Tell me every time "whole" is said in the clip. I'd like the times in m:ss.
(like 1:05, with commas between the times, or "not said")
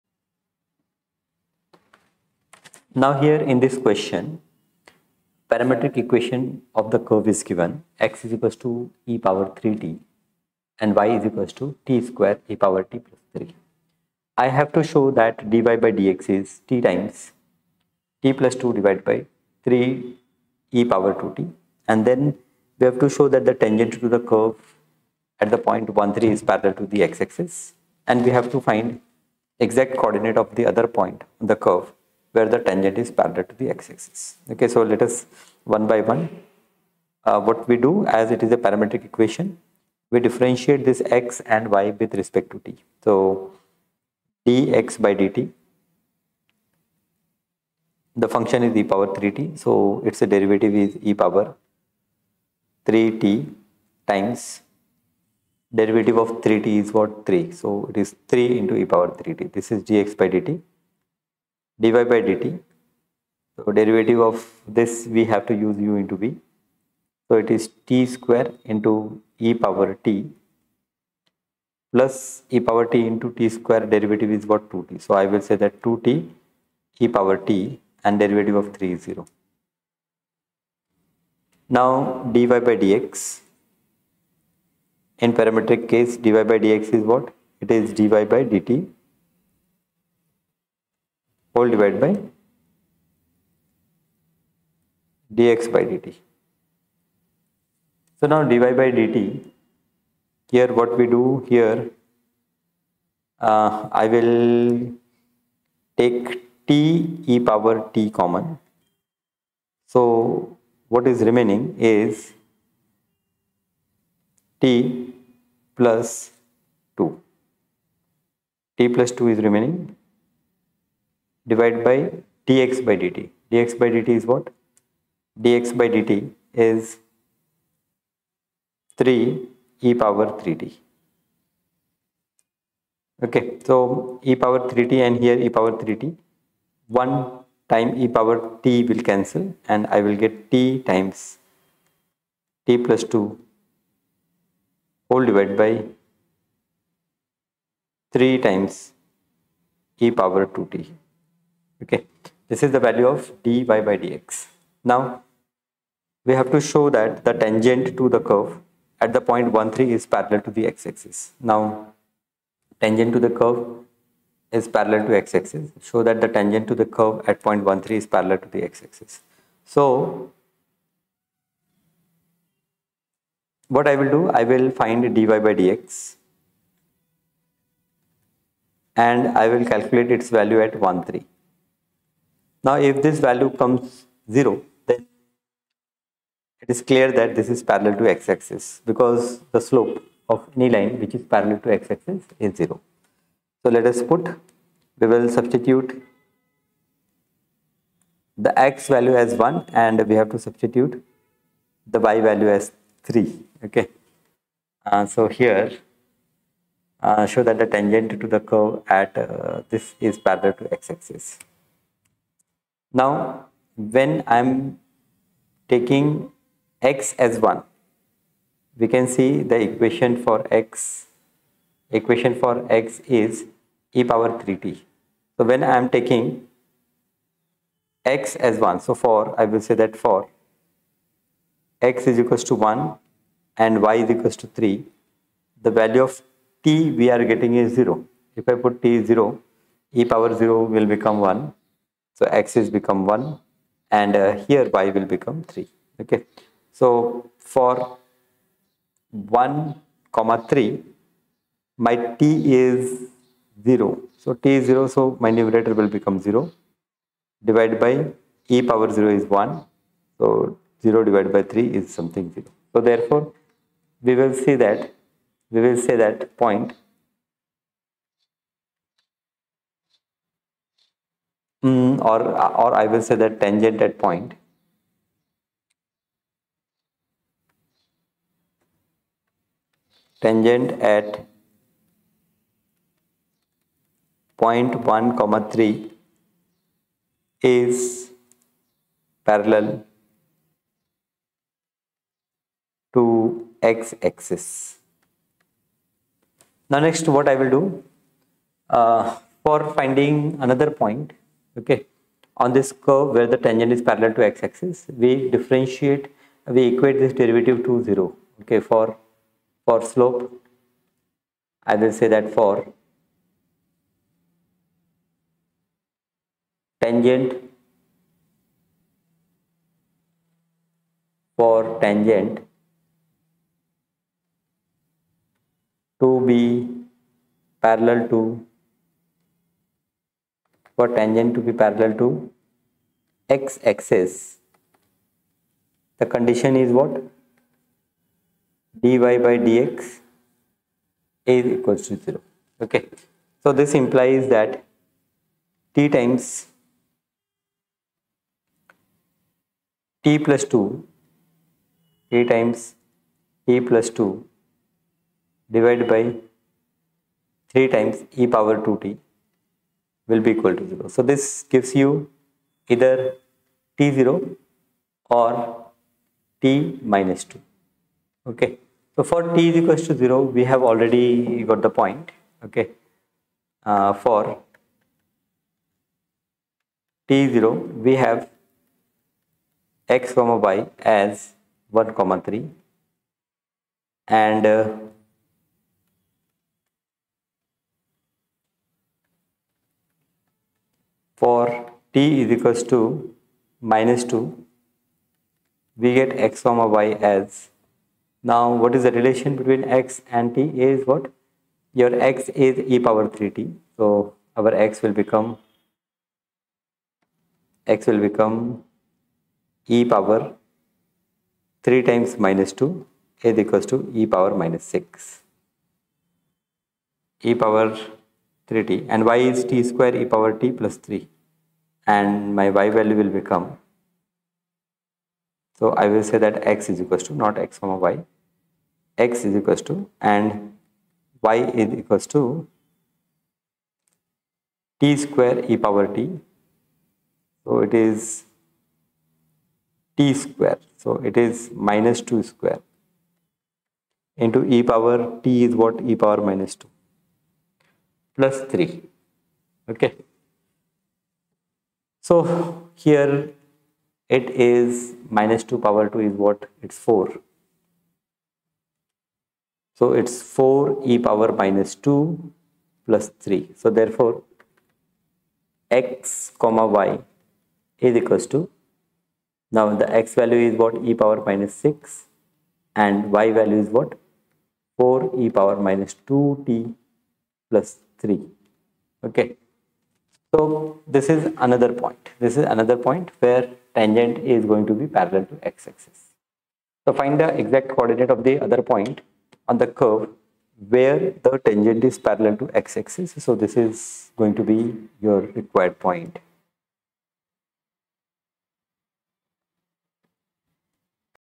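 1:31, 2:25.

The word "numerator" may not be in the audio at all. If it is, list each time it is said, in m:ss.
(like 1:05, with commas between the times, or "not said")
4:15.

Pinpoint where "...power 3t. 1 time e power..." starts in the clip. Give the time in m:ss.
2:15.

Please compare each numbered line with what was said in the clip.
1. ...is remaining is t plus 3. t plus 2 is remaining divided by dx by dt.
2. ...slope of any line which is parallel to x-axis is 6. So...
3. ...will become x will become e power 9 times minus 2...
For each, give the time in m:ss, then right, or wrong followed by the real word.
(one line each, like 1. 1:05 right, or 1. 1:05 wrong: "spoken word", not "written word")
1. 1:51 wrong: "2", not "3"
2. 3:09 wrong: "0", not "6"
3. 6:44 wrong: "3", not "9".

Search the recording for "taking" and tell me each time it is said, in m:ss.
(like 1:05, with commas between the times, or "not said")
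3:35, 3:45.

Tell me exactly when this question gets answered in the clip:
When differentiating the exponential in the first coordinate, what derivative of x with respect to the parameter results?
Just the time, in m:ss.
0:58.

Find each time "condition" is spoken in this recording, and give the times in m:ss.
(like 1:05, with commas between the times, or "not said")
5:36.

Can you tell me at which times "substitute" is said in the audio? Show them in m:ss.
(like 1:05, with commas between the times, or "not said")
3:15, 3:20.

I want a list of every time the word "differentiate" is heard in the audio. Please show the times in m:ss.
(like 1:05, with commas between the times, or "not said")
0:40, 5:05.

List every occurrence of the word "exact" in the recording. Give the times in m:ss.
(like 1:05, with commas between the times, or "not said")
0:29, 8:07.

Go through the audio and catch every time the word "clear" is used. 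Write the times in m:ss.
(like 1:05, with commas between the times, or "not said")
3:06.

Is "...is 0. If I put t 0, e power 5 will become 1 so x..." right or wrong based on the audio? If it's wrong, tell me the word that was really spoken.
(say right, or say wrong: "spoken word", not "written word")
wrong: "0", not "5".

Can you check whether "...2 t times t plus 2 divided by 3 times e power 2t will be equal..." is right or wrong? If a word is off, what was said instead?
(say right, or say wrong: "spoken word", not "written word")
right.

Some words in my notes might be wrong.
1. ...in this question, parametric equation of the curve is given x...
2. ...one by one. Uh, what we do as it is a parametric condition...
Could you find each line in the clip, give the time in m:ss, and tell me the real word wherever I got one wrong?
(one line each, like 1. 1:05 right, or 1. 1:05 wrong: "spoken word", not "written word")
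1. 0:03 right
2. 0:35 wrong: "equation", not "condition".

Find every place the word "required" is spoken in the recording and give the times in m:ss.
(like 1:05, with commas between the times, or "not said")
8:15.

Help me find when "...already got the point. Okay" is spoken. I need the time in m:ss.
6:10.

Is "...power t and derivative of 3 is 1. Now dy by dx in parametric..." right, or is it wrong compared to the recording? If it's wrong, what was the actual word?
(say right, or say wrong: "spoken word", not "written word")
wrong: "0", not "1".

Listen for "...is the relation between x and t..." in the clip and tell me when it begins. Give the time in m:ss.
6:38.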